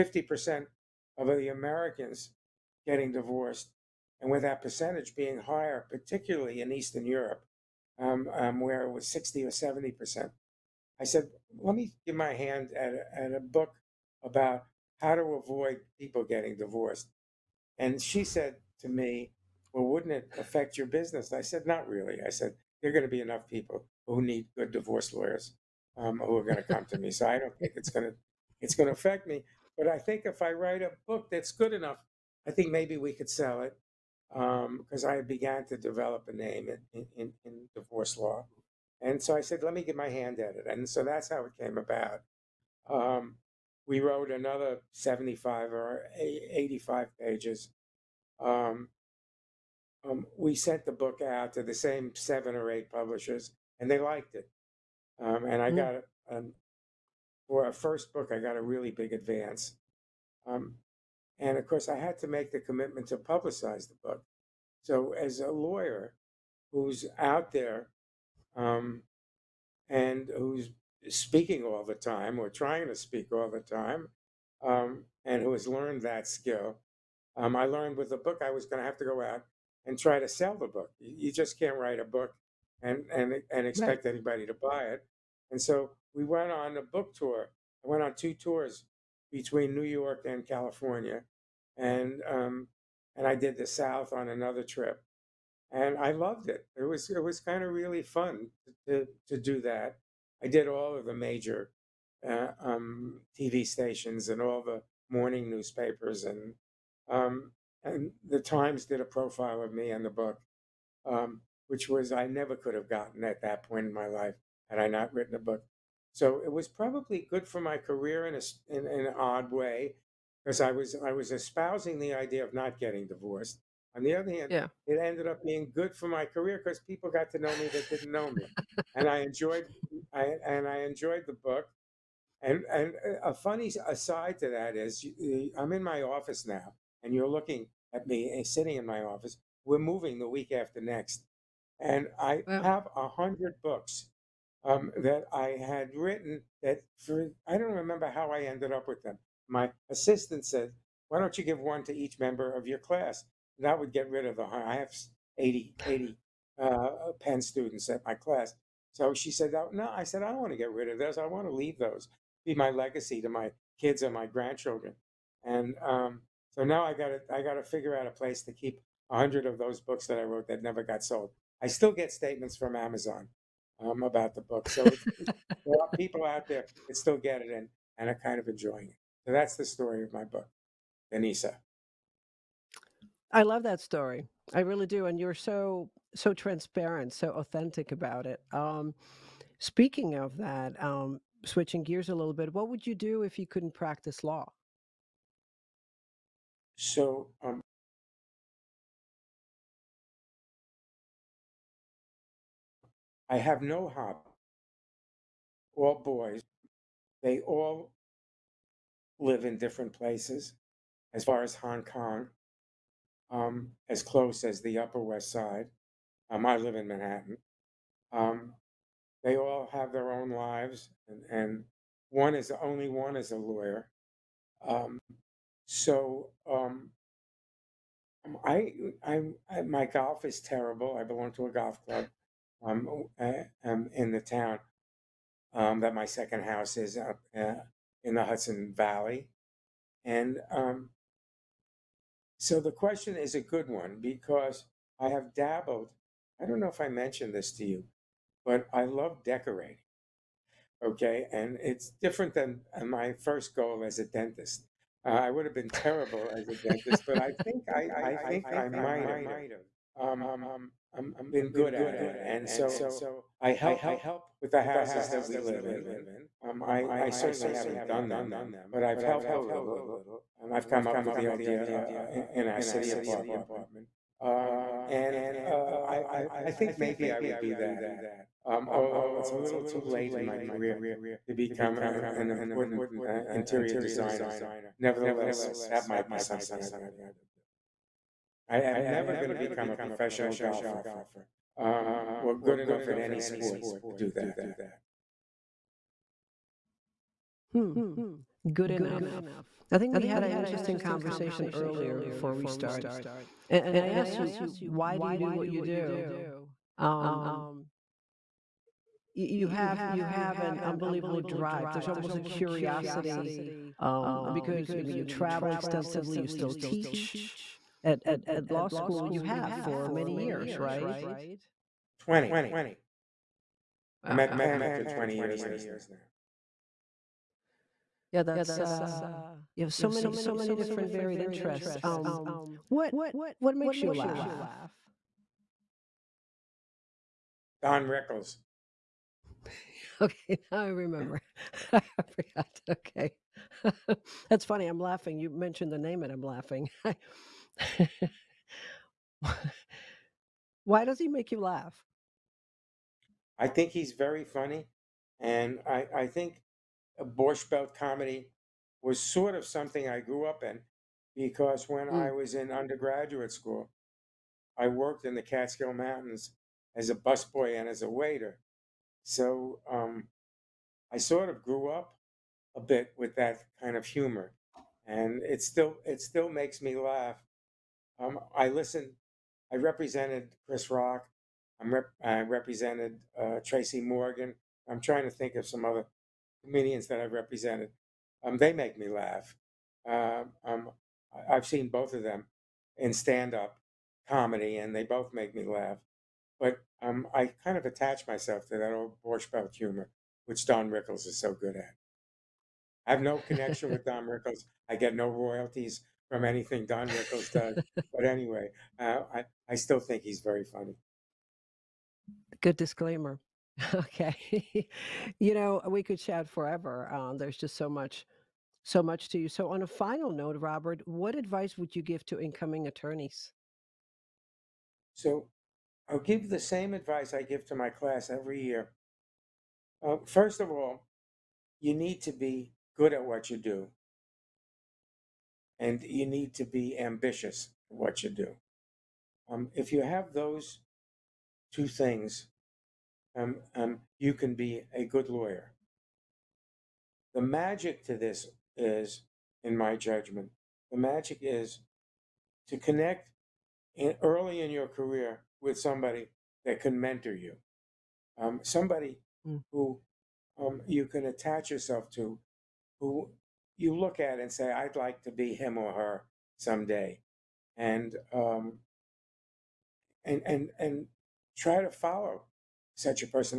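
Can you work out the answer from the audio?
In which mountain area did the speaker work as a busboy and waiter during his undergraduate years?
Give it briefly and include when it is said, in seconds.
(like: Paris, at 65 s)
Catskill Mountains, at 365 s.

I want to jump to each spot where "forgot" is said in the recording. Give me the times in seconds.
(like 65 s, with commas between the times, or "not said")
341 s.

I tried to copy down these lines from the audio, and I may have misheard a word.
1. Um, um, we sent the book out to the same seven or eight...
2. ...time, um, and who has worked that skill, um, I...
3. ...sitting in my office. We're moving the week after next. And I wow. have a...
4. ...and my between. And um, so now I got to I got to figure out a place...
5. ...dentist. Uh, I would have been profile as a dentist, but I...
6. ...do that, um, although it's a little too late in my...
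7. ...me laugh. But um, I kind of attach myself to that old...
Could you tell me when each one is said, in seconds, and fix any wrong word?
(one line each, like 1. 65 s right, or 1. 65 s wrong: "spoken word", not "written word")
1. 48 s right
2. 73 s wrong: "learned", not "worked"
3. 138 s right
4. 164 s wrong: "grandchildren", not "between"
5. 254 s wrong: "terrible", not "profile"
6. 277 s right
7. 395 s right.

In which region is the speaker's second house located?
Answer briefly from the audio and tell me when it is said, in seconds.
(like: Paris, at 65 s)
Hudson Valley, at 238 s.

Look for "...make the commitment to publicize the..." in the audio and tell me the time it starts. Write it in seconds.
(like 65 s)
62 s.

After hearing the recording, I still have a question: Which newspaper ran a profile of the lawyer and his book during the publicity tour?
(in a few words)
The Times.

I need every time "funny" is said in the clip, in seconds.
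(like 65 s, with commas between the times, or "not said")
133 s, 344 s, 354 s, 410 s.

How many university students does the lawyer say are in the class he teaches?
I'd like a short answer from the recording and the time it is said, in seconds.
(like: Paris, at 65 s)
80, at 155 s.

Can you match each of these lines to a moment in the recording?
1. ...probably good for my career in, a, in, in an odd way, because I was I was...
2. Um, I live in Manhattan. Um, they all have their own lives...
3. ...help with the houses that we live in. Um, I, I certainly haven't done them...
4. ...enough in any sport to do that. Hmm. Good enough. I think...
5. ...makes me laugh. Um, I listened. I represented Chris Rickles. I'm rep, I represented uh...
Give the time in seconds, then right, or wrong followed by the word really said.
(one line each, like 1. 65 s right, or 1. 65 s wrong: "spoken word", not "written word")
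1. 116 s right
2. 216 s right
3. 263 s right
4. 292 s right
5. 376 s wrong: "Rock", not "Rickles".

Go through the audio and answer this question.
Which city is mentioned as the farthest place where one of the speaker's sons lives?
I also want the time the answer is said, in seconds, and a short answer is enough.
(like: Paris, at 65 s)
Hong Kong, at 211 s.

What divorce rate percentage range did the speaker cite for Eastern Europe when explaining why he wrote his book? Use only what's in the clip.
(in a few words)
60 or 70%.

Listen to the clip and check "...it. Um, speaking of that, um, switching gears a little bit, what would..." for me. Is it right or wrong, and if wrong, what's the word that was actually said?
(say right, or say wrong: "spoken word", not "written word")
right.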